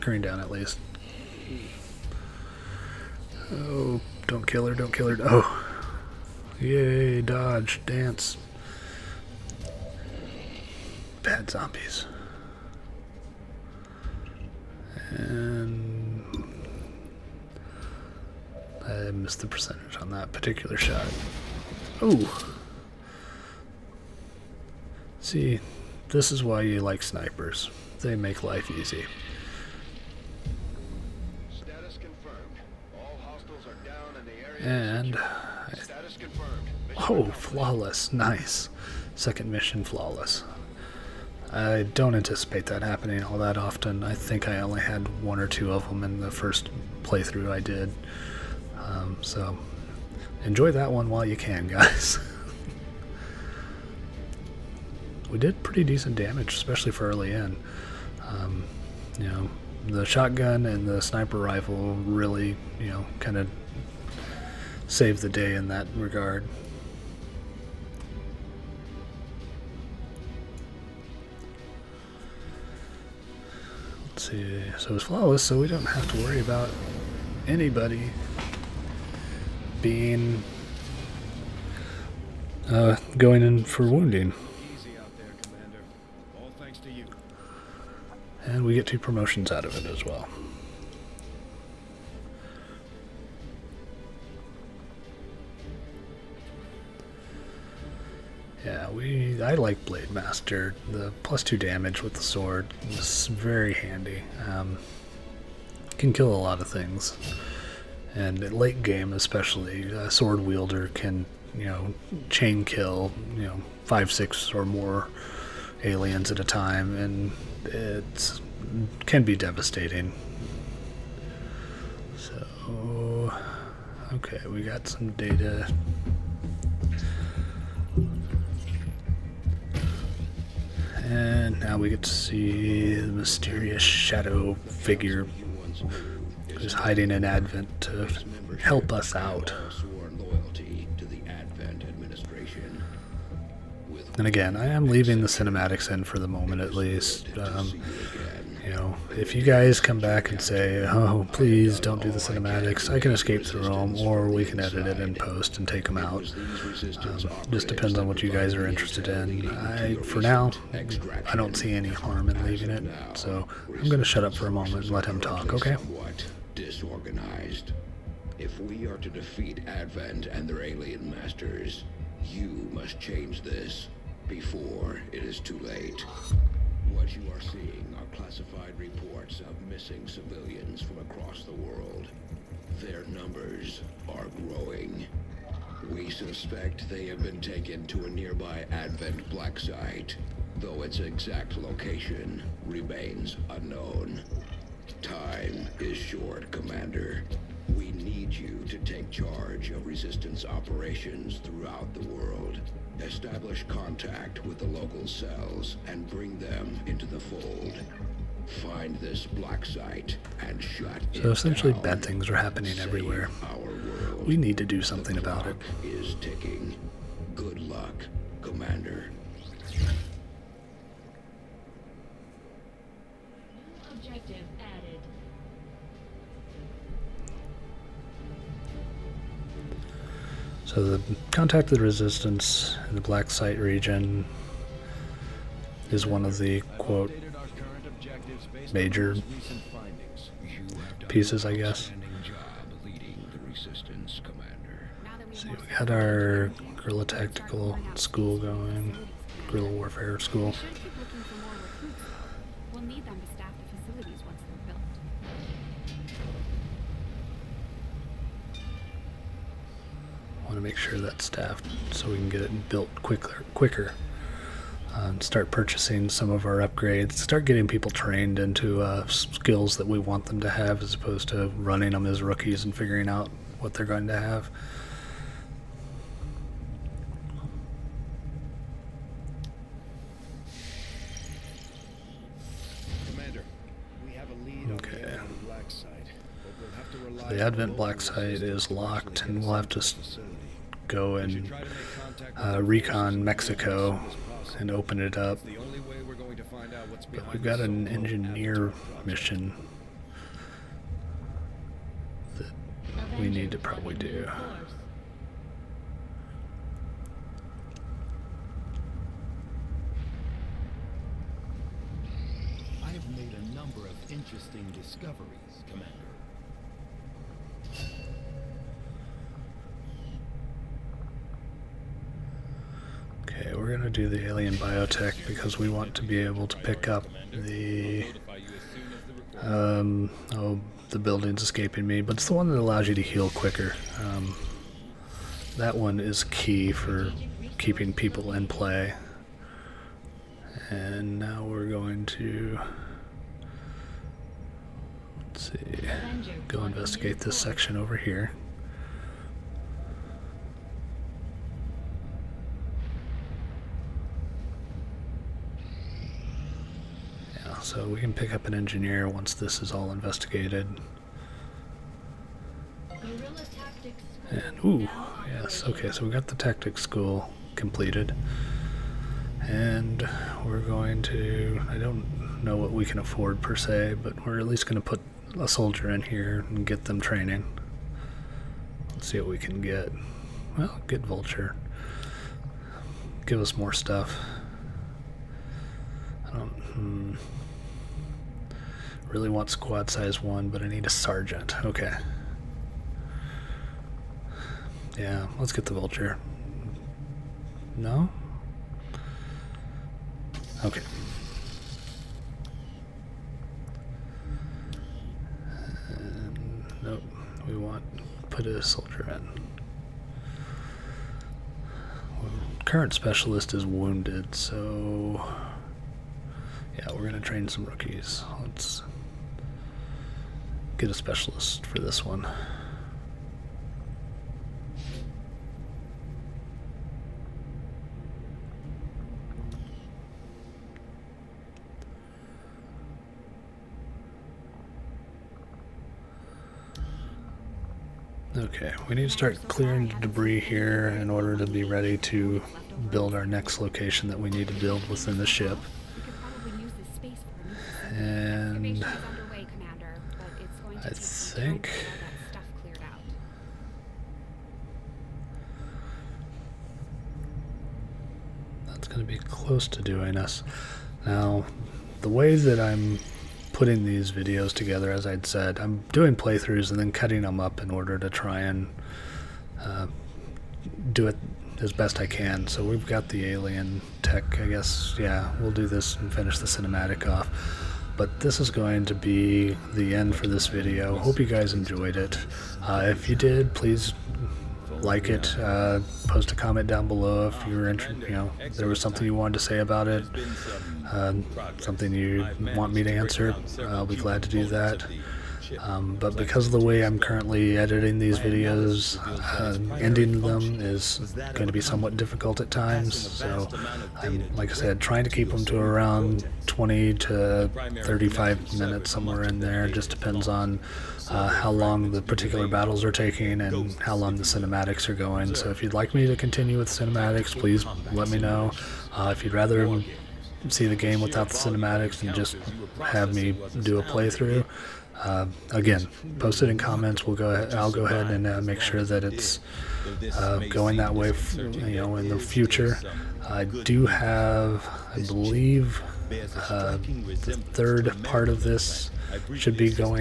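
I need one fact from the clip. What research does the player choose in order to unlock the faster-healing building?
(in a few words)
Alien biotech.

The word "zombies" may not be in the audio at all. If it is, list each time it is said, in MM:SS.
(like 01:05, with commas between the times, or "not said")
00:11.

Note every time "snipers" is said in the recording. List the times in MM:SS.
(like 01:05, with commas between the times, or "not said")
00:27, 01:01.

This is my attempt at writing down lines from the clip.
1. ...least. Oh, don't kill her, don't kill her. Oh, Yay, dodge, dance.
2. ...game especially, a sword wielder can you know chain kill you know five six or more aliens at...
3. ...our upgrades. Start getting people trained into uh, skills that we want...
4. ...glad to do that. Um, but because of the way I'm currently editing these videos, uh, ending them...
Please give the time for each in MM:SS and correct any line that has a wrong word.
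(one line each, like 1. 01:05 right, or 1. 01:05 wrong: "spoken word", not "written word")
1. 00:00 right
2. 01:48 right
3. 04:26 right
4. 08:13 right.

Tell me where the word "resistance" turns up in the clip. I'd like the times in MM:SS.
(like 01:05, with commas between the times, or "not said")
03:19, 03:51.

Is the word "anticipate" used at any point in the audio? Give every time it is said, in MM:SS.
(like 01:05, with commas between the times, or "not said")
00:42.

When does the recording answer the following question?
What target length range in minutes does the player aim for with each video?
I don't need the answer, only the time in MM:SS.
08:26.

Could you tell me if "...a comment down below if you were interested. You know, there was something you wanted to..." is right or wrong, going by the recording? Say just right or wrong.
right.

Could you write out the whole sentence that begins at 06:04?
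And, ooh, yes, okay, so we got the tactics school completed.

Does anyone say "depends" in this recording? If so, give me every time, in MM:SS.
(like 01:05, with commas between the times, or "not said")
02:37, 08:29.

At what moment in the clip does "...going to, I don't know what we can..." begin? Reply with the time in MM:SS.
06:10.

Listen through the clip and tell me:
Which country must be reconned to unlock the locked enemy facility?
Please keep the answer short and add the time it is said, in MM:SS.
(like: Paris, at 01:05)
Mexico, at 04:53.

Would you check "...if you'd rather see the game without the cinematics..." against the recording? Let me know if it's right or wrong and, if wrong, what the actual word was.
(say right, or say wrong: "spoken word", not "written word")
right.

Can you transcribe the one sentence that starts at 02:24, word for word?
And again, I am leaving the cinematics in for the moment at least.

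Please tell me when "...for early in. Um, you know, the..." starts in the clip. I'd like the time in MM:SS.
00:56.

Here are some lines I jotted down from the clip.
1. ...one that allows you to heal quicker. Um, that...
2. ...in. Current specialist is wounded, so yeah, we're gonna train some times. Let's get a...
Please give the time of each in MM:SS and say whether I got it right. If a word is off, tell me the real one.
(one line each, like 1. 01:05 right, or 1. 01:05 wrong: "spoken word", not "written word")
1. 05:32 right
2. 06:49 wrong: "rookies", not "times".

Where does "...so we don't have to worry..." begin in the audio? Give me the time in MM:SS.
01:15.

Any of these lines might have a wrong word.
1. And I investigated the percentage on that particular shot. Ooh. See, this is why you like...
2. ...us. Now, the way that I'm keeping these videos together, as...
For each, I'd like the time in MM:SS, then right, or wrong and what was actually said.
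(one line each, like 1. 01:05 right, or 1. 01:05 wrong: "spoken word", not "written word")
1. 00:15 wrong: "missed", not "investigated"
2. 07:40 wrong: "putting", not "keeping".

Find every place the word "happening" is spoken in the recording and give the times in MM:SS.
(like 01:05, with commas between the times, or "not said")
00:42, 03:32.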